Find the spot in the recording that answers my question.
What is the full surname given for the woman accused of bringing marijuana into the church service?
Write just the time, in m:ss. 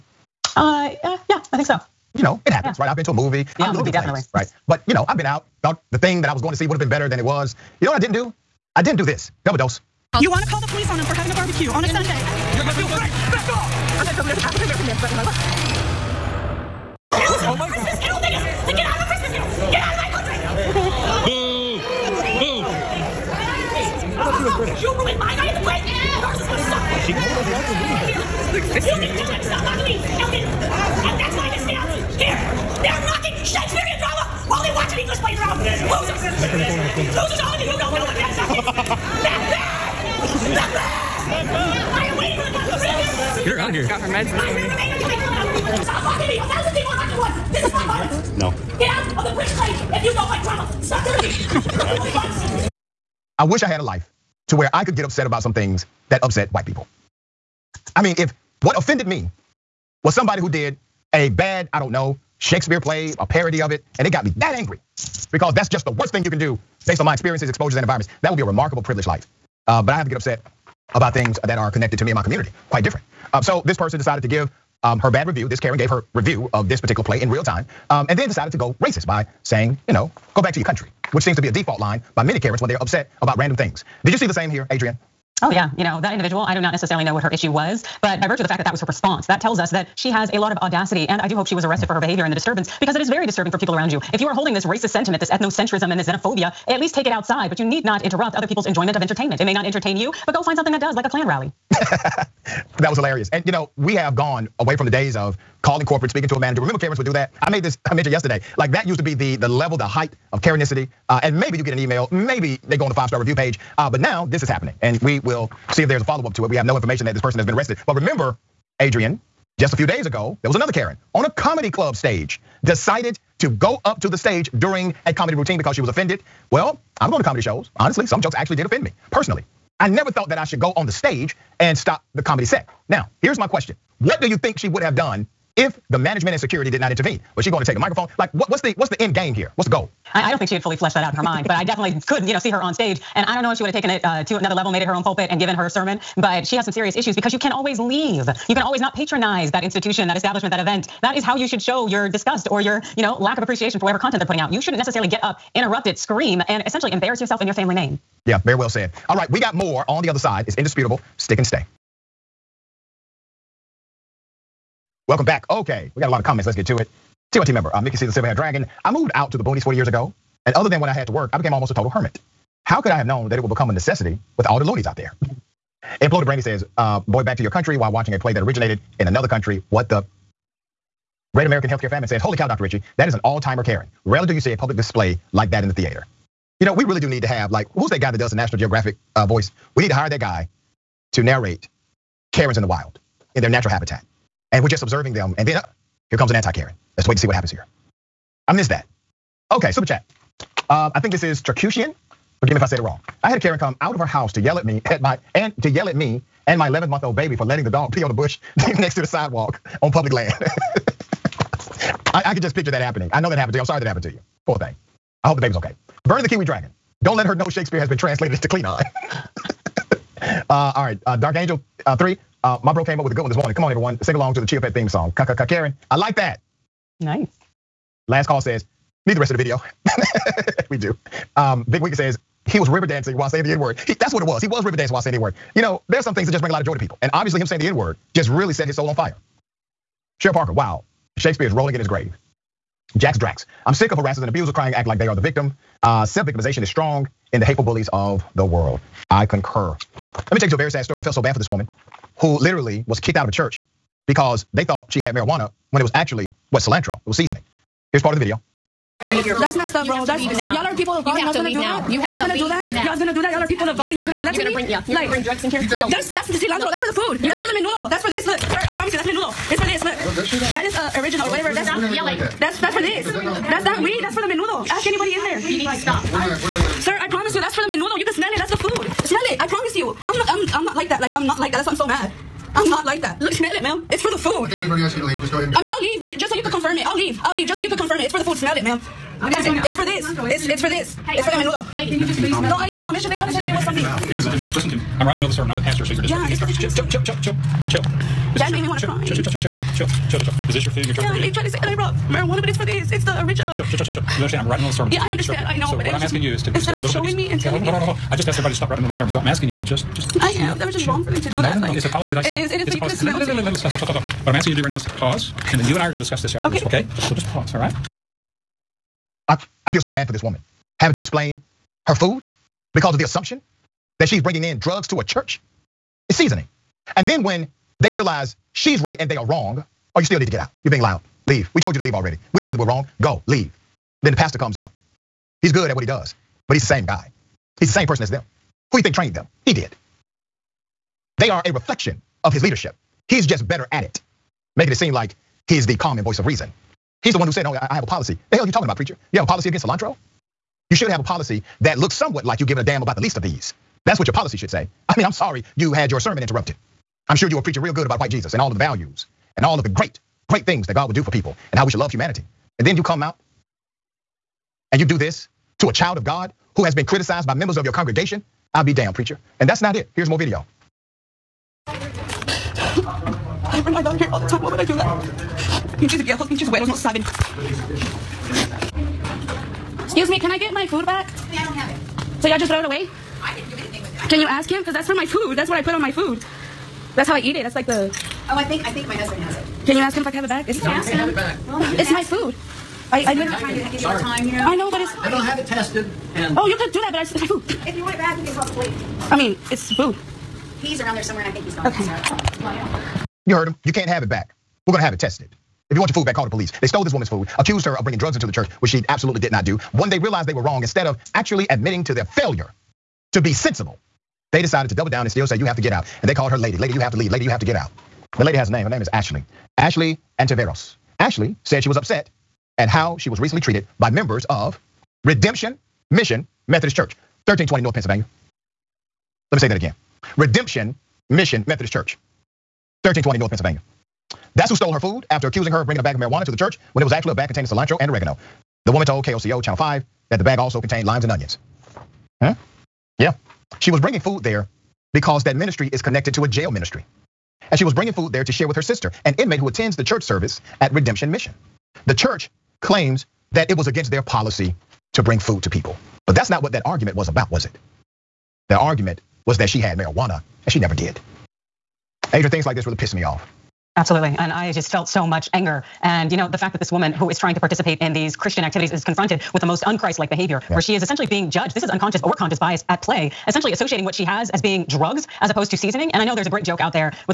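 7:00.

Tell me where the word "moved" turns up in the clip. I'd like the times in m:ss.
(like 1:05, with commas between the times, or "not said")
2:48.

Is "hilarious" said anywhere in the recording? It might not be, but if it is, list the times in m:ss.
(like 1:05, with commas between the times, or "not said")
1:42.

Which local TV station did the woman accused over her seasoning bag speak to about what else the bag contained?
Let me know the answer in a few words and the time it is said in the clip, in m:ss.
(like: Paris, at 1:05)
KOCO Channel 5, at 7:19.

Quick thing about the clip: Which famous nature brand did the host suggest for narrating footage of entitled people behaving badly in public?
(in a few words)
National Geographic.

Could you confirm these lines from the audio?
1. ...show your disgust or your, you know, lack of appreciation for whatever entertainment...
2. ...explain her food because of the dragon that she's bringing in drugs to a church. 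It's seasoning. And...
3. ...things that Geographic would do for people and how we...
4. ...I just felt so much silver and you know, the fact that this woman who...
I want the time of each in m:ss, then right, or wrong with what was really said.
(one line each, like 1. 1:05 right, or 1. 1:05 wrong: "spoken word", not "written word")
1. 2:31 wrong: "content", not "entertainment"
2. 5:20 wrong: "assumption", not "dragon"
3. 6:00 wrong: "God", not "Geographic"
4. 7:44 wrong: "anger", not "silver".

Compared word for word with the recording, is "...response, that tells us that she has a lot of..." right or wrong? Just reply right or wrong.
right.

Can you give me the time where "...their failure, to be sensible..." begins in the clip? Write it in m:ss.
6:51.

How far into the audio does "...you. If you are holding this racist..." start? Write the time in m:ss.
1:33.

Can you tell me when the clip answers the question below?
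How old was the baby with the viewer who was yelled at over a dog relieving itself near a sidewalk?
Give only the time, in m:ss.
3:26.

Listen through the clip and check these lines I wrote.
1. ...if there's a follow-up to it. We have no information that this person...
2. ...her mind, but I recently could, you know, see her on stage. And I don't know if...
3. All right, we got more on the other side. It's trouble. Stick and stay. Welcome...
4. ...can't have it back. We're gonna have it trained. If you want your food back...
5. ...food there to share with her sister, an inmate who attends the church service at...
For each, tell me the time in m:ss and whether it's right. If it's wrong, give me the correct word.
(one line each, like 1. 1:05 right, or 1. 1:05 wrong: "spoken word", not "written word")
1. 1:55 right
2. 2:21 wrong: "definitely", not "recently"
3. 2:39 wrong: "indisputable", not "trouble"
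4. 6:43 wrong: "tested", not "trained"
5. 7:27 right.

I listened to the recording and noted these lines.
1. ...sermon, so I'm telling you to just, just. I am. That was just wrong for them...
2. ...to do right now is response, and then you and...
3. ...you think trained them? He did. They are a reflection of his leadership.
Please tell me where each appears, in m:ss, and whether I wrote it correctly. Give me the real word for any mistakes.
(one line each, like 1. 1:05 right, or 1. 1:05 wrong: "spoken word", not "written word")
1. 5:08 wrong: "asking", not "telling"
2. 5:14 wrong: "pause", not "response"
3. 5:38 right.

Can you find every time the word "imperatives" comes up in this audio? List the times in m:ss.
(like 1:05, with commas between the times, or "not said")
not said.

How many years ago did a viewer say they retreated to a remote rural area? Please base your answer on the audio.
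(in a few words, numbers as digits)
40.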